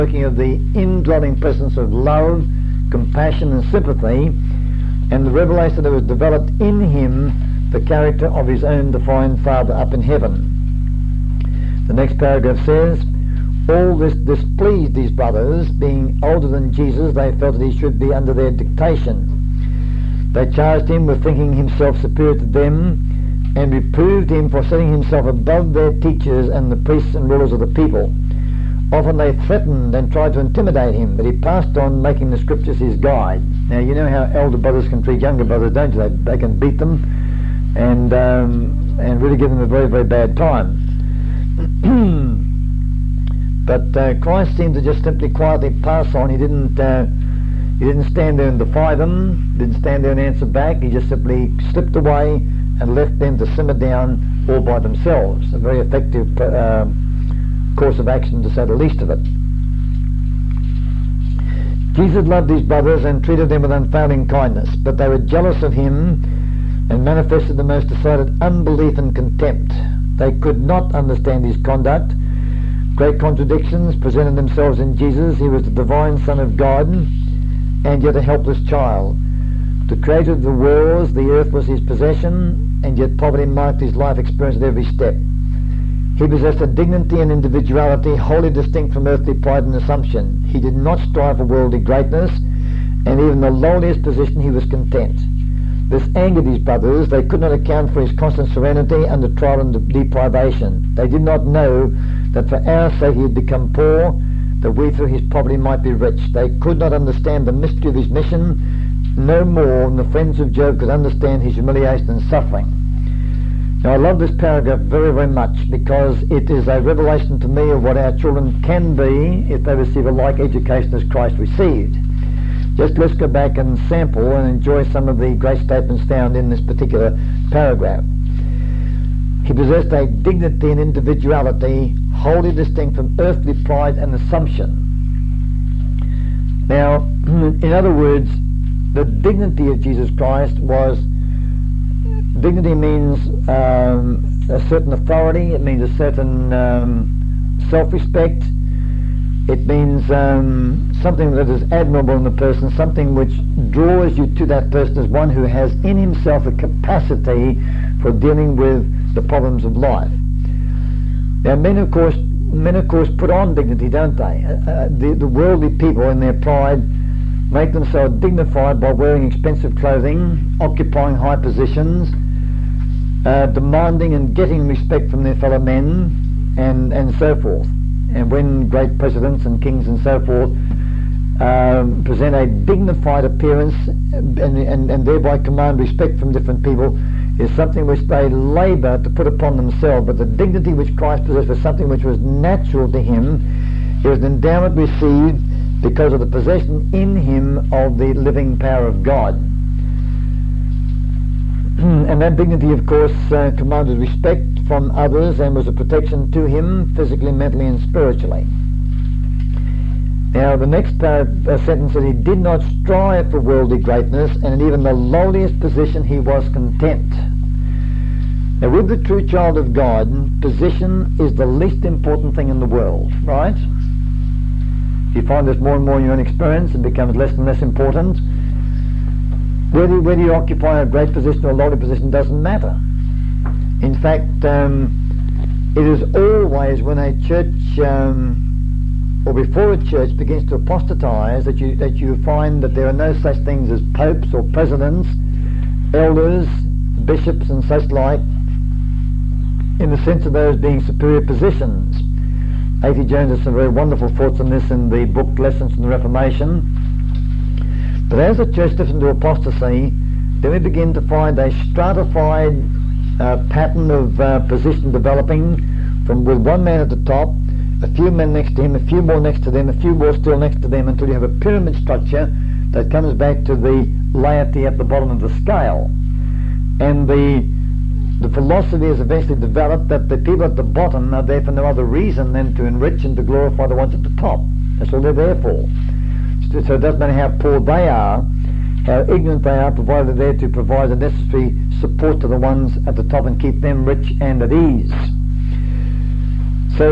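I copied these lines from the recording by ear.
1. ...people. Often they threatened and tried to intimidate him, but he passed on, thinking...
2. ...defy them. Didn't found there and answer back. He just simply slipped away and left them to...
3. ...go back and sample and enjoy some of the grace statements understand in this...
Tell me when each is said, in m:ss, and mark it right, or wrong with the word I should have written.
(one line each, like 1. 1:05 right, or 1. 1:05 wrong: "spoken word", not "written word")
1. 0:27 wrong: "making", not "thinking"
2. 0:48 wrong: "stand", not "found"
3. 2:03 wrong: "found", not "understand".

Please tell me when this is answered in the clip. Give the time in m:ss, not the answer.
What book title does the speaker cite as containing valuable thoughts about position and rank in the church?
4:15.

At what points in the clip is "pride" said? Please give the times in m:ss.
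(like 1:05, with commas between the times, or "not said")
1:29, 2:13, 2:46.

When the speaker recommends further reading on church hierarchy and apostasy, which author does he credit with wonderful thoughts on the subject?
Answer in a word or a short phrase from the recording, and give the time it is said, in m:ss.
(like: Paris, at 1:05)
A.T. Jones, at 4:12.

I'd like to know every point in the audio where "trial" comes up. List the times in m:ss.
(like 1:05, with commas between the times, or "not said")
1:39.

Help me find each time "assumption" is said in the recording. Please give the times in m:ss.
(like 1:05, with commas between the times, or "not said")
1:29, 2:14.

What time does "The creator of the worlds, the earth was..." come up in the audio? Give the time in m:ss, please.
1:19.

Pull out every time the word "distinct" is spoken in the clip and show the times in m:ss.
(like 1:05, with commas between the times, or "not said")
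1:28, 2:12.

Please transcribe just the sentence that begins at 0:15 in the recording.
Being older than Jesus, they felt that he should be under their dictation.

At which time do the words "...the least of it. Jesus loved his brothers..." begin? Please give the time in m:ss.
0:58.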